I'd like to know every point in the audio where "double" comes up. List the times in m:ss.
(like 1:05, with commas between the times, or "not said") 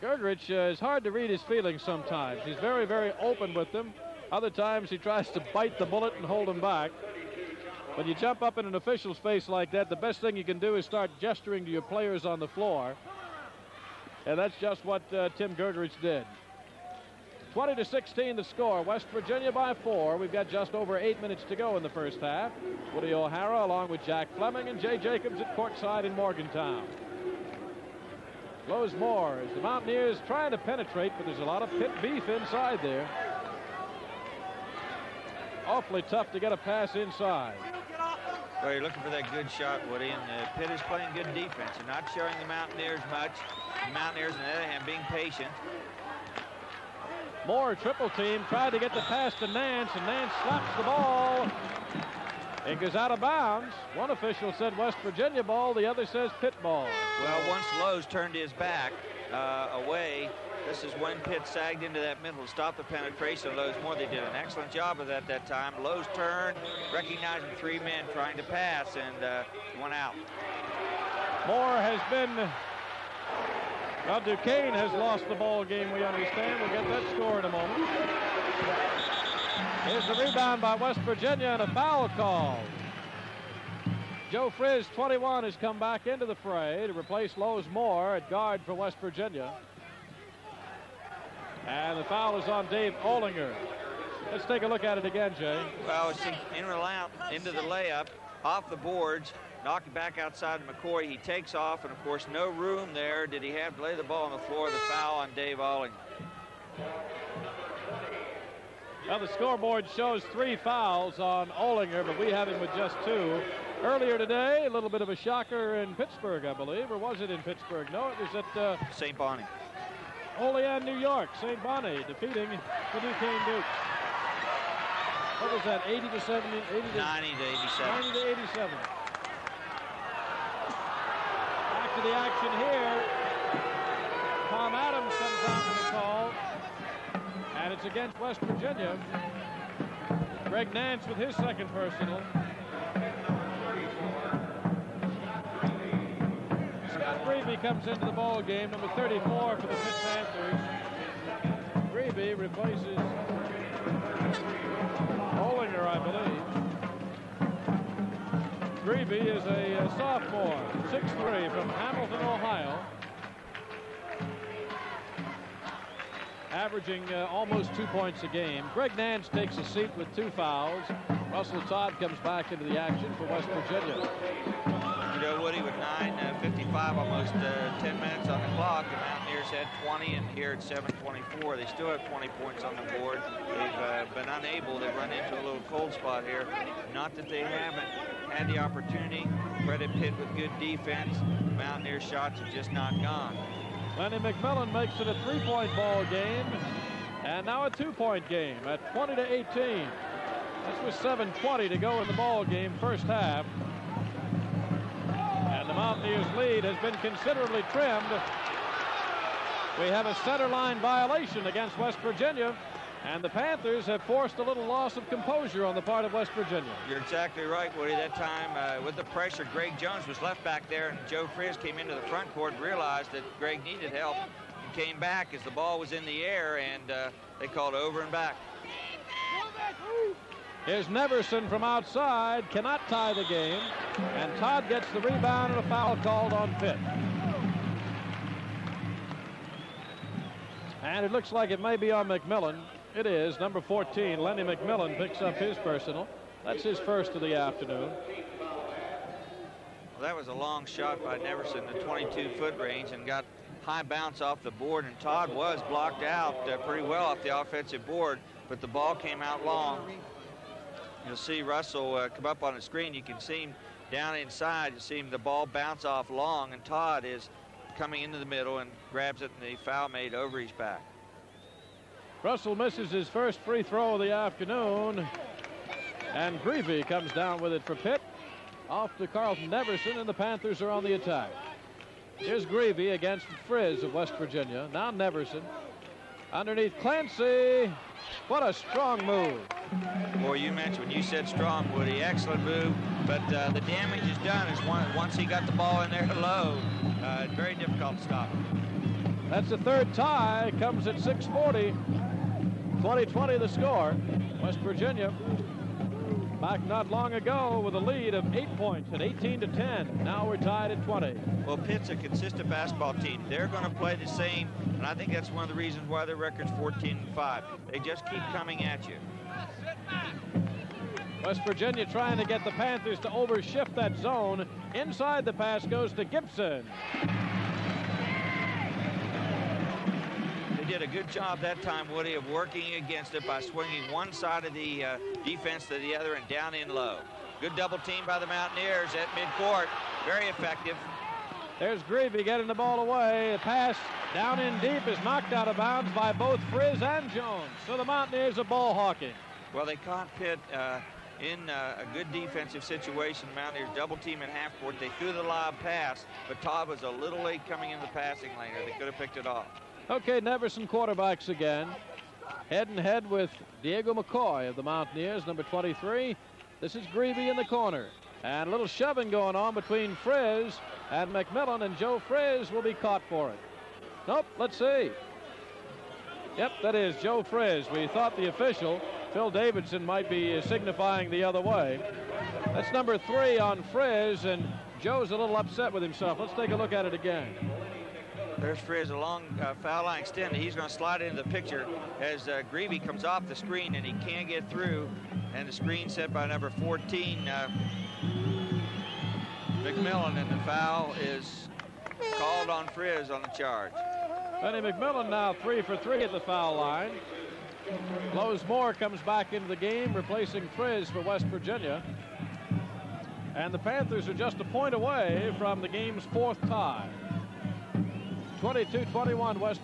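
5:37, 5:53.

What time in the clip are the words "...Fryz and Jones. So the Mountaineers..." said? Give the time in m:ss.
5:46.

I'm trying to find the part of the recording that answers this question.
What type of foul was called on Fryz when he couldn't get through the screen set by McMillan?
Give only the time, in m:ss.
6:43.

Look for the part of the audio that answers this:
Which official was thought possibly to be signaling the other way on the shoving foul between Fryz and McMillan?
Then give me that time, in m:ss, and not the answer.
6:19.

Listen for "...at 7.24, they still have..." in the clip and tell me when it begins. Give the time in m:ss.
3:00.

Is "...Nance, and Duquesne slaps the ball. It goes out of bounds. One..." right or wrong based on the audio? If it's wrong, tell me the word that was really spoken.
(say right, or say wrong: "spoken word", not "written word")
wrong: "Nance", not "Duquesne".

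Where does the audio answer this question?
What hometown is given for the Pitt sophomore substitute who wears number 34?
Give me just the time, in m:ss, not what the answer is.
2:41.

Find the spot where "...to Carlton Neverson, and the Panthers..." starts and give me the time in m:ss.
4:38.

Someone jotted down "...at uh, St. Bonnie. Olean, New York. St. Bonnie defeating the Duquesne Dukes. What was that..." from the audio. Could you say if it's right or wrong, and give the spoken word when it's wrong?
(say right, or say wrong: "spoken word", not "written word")
right.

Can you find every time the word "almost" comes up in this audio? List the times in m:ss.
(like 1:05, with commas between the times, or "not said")
2:47, 2:56.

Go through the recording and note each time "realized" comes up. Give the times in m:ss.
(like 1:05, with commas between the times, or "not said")
3:42.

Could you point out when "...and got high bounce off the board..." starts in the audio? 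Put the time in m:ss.
4:12.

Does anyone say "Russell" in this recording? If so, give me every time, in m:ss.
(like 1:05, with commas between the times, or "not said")
2:51, 4:21, 4:32.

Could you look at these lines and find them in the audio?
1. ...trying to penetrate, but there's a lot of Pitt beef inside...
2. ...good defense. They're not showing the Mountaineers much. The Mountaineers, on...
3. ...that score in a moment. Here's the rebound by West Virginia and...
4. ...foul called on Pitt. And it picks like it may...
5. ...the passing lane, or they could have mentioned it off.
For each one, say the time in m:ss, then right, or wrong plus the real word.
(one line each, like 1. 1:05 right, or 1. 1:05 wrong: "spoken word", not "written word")
1. 0:30 right
2. 0:41 right
3. 1:16 right
4. 3:55 wrong: "looks", not "picks"
5. 5:57 wrong: "picked", not "mentioned".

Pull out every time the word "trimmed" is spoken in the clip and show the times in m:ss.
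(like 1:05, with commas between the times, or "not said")
3:27.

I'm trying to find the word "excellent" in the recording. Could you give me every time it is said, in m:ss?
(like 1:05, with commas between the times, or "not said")
1:04, 4:52.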